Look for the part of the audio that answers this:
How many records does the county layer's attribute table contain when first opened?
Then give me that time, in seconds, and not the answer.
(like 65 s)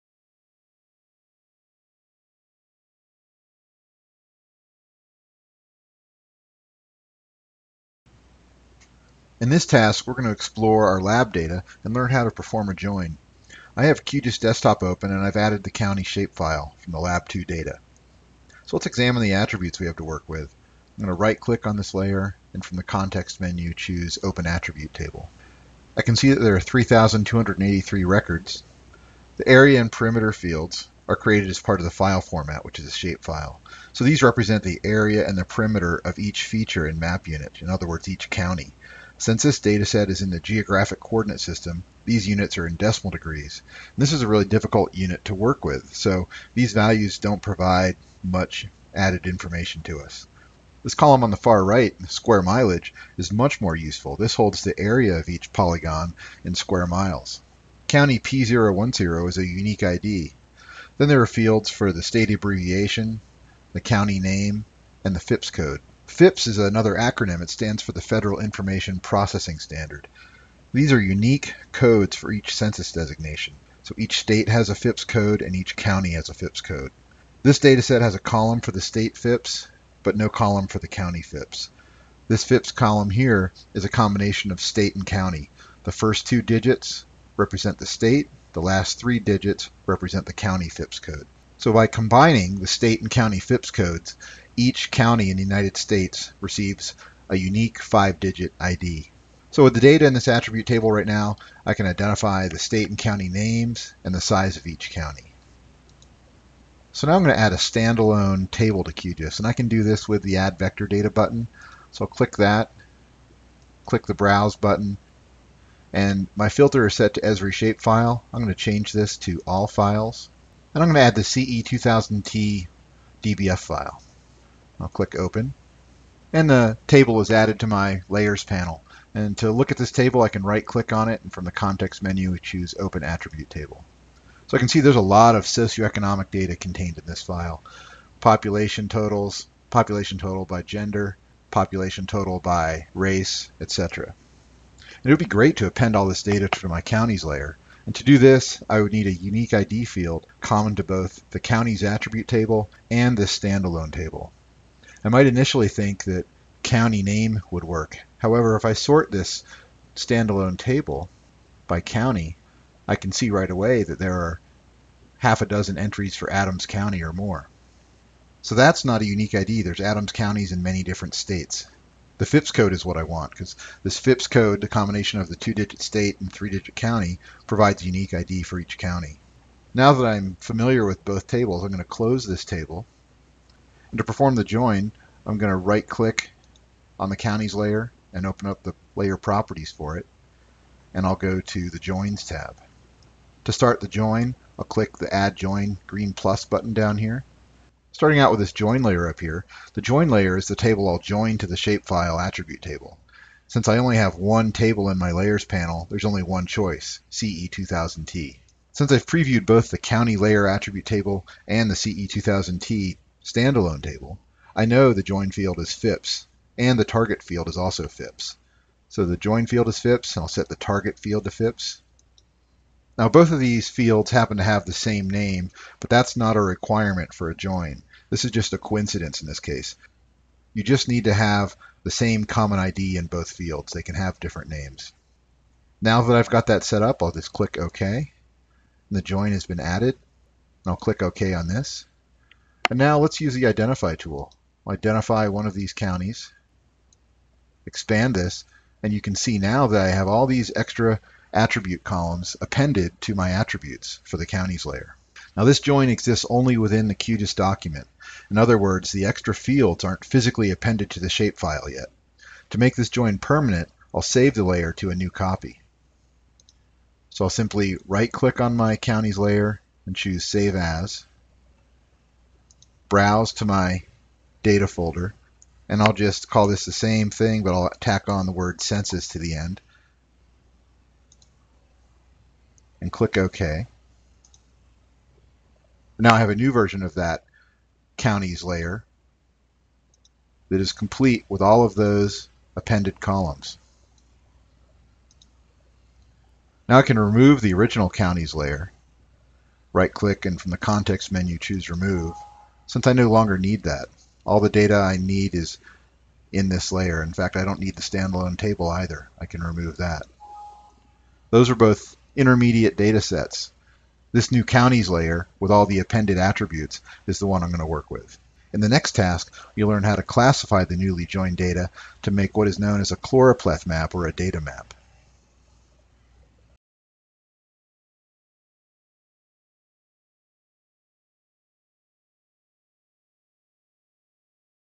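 26 s.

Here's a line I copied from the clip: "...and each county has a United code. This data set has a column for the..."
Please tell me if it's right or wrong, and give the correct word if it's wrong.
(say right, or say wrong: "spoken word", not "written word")
wrong: "FIPS", not "United".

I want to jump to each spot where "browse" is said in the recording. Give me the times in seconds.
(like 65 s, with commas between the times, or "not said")
114 s, 272 s.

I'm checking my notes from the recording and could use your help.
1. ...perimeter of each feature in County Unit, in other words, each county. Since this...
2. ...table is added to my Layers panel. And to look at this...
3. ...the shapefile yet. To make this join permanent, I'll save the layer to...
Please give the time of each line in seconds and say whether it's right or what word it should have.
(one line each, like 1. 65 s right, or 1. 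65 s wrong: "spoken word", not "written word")
1. 35 s wrong: "Map", not "County"
2. 126 s right
3. 260 s right.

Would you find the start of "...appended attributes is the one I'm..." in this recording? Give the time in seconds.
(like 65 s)
315 s.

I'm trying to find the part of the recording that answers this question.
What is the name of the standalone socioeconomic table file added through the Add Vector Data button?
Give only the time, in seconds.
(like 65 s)
121 s.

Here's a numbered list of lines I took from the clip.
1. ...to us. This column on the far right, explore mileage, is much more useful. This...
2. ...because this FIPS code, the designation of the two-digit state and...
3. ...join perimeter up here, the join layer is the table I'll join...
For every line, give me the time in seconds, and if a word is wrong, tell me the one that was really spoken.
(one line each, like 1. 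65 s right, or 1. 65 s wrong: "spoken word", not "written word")
1. 49 s wrong: "square", not "explore"
2. 173 s wrong: "combination", not "designation"
3. 198 s wrong: "layer", not "perimeter".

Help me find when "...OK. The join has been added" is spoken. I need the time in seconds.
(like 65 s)
237 s.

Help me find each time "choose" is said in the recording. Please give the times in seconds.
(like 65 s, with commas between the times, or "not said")
23 s, 132 s, 269 s, 301 s.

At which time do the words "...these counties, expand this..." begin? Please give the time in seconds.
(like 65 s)
245 s.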